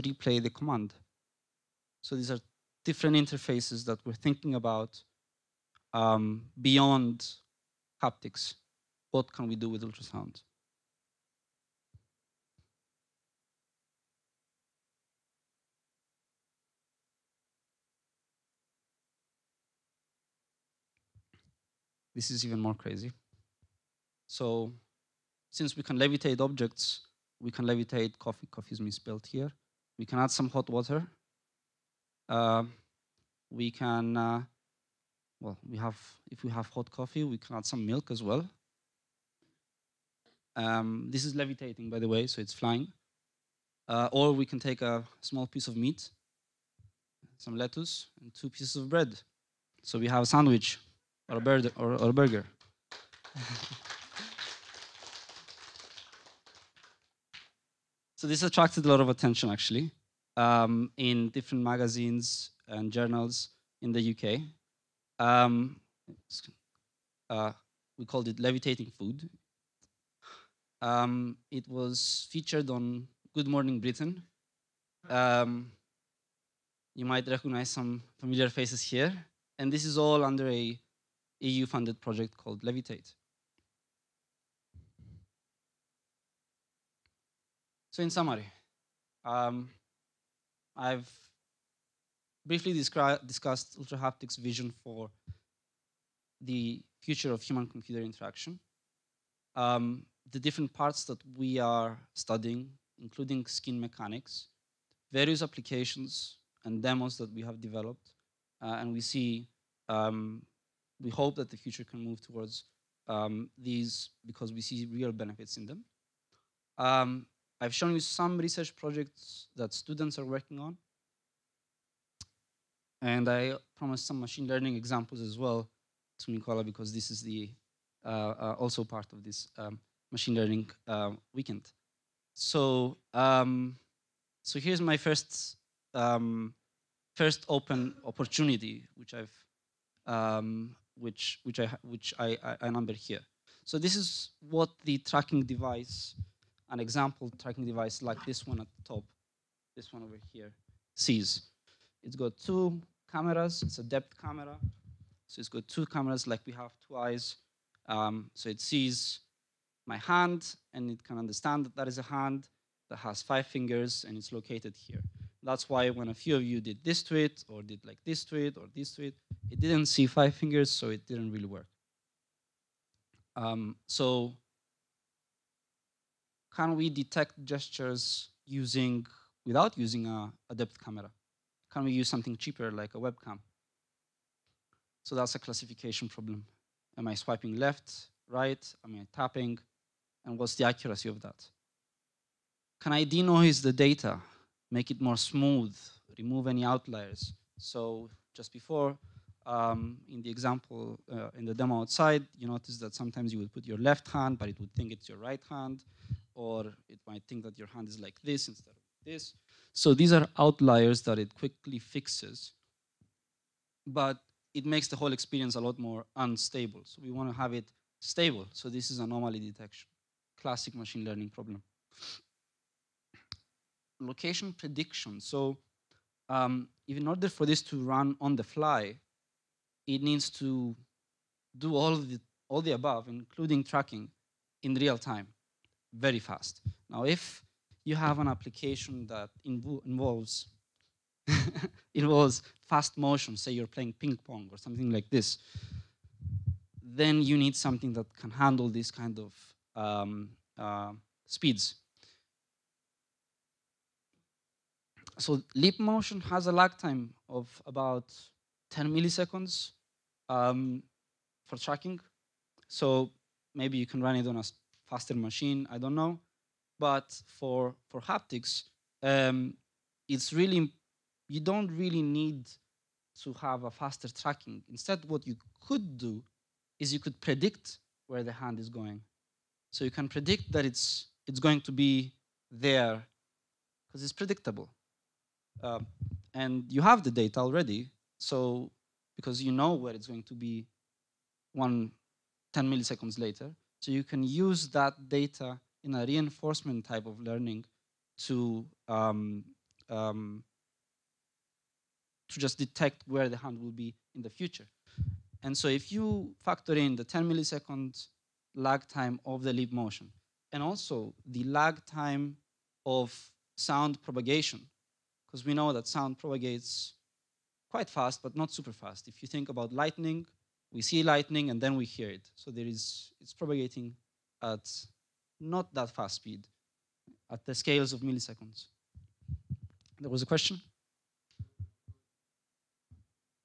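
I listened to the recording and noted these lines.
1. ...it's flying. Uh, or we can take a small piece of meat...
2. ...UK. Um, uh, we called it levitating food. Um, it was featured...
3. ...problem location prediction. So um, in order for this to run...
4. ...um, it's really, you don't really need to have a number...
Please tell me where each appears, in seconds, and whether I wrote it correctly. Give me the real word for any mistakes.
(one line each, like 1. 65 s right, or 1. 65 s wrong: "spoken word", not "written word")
1. 42 s right
2. 64 s right
3. 221 s right
4. 269 s wrong: "faster", not "number".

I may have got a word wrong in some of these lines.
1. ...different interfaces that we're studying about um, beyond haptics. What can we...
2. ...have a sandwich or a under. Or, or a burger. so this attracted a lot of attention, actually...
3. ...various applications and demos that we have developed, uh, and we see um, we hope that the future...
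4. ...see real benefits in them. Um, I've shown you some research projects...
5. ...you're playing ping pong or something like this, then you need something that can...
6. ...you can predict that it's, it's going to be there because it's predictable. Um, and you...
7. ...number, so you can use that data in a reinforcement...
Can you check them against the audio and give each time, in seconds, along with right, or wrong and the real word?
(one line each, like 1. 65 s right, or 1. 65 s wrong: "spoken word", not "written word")
1. 2 s wrong: "thinking", not "studying"
2. 50 s wrong: "burger", not "under"
3. 105 s right
4. 114 s right
5. 243 s right
6. 279 s right
7. 293 s wrong: "later", not "number".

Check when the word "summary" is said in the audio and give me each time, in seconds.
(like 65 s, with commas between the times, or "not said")
88 s.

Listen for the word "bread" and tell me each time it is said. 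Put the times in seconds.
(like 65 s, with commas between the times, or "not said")
48 s.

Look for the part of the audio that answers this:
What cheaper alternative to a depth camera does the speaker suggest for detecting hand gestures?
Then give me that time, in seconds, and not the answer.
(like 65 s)
182 s.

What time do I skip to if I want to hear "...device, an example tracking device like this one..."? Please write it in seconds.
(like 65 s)
145 s.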